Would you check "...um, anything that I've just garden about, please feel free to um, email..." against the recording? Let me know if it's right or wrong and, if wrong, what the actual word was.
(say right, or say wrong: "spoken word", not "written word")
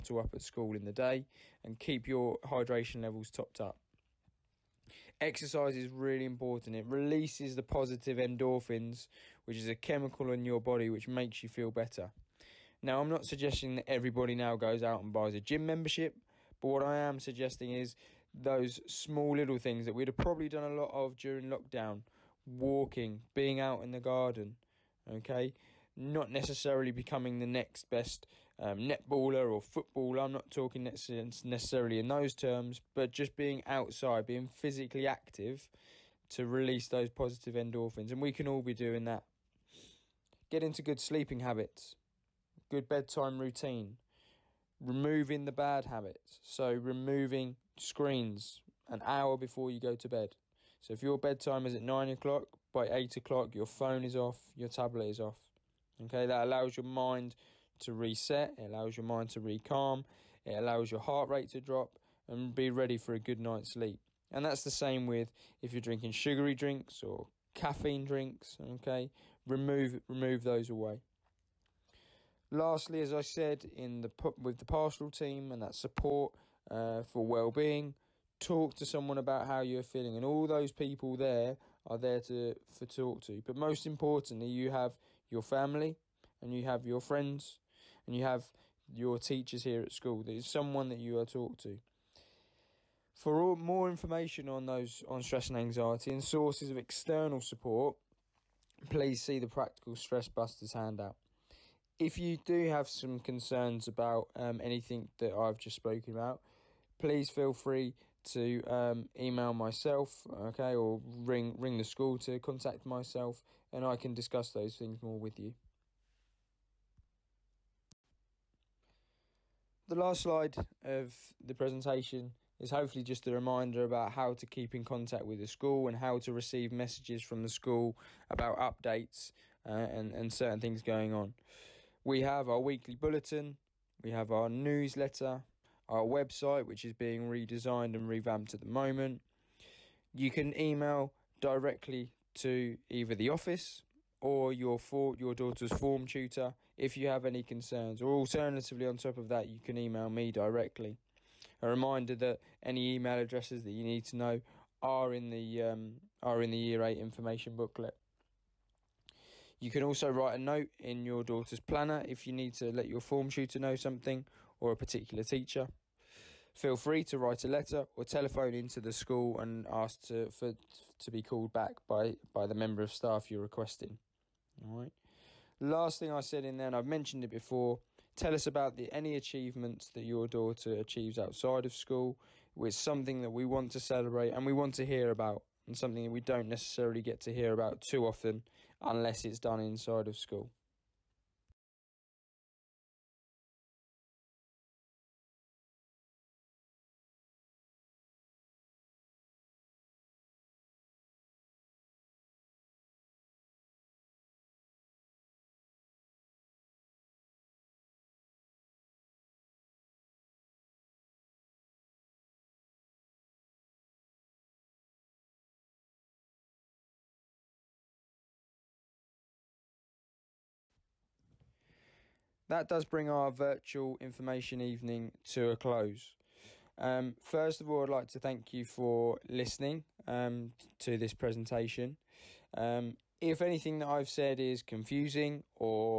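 wrong: "spoken", not "garden".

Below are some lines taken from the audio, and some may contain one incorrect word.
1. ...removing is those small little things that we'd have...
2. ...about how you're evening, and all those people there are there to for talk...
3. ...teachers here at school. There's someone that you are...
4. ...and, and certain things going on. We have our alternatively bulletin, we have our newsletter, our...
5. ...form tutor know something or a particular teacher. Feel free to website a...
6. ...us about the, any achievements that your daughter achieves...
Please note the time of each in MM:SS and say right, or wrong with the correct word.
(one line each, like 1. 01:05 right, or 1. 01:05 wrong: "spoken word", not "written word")
1. 00:17 wrong: "suggesting", not "removing"
2. 01:19 wrong: "feeling", not "evening"
3. 01:29 right
4. 02:09 wrong: "weekly", not "alternatively"
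5. 02:43 wrong: "write", not "website"
6. 02:58 right.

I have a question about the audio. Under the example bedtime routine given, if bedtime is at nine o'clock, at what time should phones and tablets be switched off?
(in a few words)
8 o'clock.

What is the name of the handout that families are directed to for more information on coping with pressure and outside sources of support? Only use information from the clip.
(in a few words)
Practical Stress Busters.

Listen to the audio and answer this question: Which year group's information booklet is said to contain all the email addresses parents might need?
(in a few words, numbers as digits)
Year 8.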